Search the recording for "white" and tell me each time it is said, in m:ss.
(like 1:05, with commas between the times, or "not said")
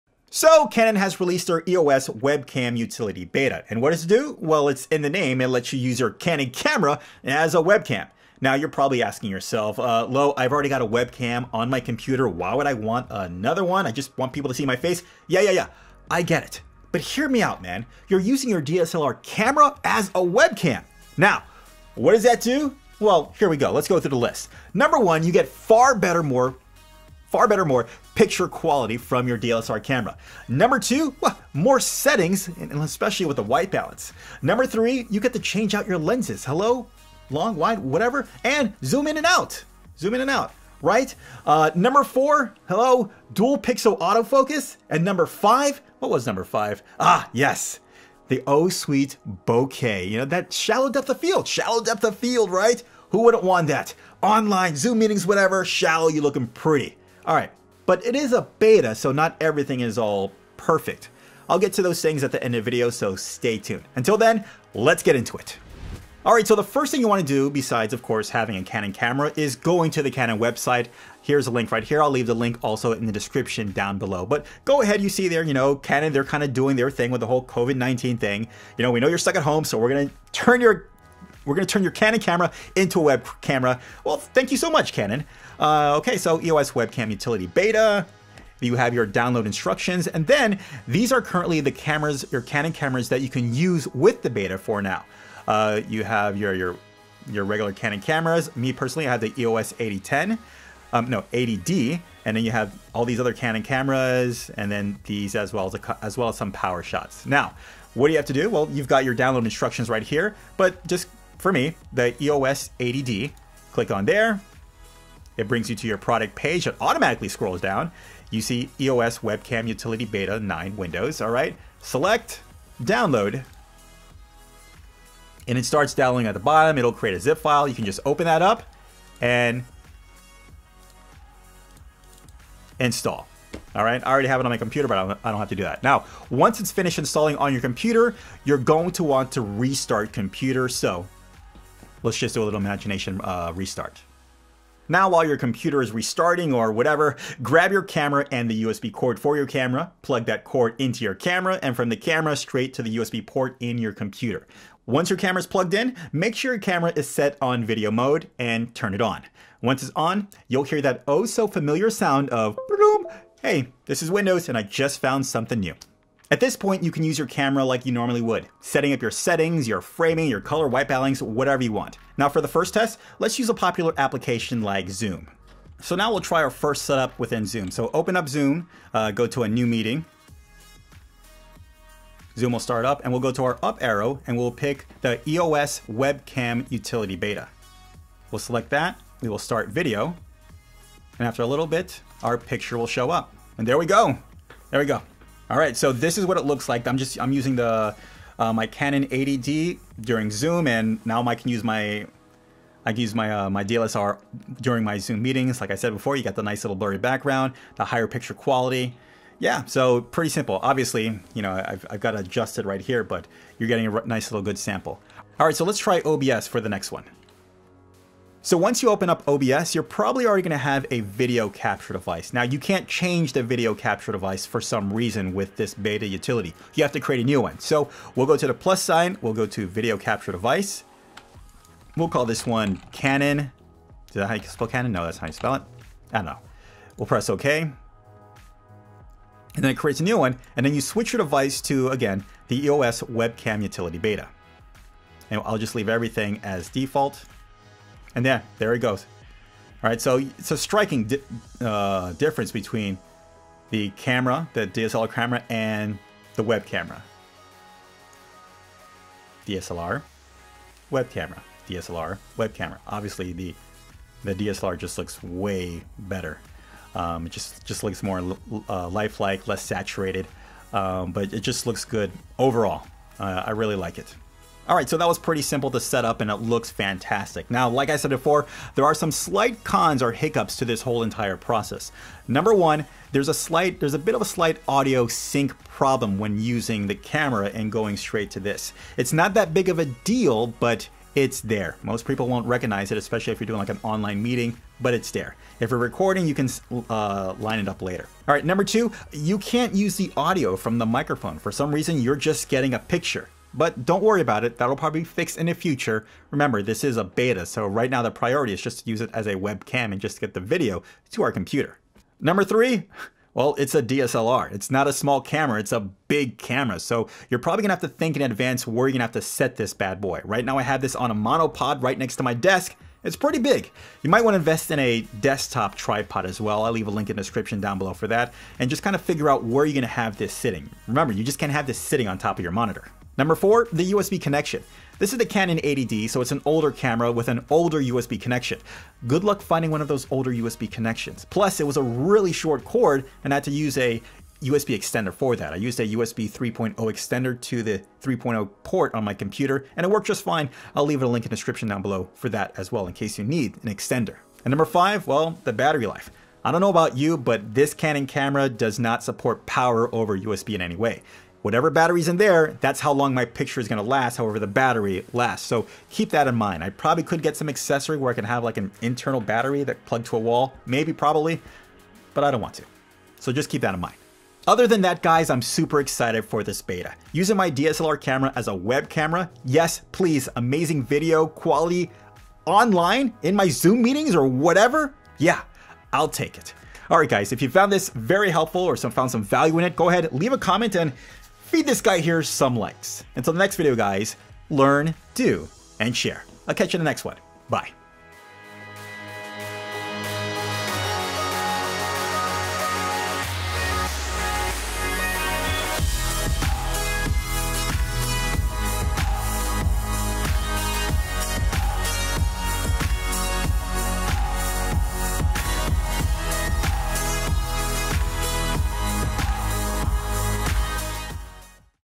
0:33, 2:50.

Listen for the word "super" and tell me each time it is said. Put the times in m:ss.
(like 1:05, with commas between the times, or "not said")
6:15.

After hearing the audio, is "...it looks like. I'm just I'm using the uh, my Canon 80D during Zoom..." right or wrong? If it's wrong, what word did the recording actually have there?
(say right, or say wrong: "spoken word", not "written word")
right.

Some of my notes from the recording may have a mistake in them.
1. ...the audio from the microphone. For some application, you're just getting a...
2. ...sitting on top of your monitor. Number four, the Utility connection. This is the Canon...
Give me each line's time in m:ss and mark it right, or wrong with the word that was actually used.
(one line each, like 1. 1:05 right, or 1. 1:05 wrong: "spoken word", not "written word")
1. 4:59 wrong: "reason", not "application"
2. 5:31 wrong: "USB", not "Utility".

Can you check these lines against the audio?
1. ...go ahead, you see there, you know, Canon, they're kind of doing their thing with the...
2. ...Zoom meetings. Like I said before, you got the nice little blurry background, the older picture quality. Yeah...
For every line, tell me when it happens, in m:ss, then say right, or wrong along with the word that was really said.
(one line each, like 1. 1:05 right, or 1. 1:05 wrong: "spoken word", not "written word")
1. 1:14 right
2. 3:24 wrong: "higher", not "older".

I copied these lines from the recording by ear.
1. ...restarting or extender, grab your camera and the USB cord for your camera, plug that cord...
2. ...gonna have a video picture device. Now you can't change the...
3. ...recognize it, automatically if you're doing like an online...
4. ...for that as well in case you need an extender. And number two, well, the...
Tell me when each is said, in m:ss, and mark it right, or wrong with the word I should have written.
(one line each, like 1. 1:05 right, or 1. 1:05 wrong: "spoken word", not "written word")
1. 2:25 wrong: "whatever", not "extender"
2. 3:40 wrong: "capture", not "picture"
3. 4:52 wrong: "especially", not "automatically"
4. 5:52 wrong: "five", not "two".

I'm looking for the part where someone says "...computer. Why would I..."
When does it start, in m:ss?
0:11.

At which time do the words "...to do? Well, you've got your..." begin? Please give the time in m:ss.
1:48.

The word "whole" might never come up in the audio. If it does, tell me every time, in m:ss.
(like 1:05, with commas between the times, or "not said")
1:17, 4:40.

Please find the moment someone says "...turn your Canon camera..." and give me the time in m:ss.
1:21.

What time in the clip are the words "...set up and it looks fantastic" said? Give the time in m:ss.
4:35.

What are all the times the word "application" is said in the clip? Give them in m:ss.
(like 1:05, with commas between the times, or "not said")
2:53.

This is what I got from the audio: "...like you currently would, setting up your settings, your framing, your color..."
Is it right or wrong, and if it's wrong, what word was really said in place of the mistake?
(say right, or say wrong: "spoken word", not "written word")
wrong: "normally", not "currently".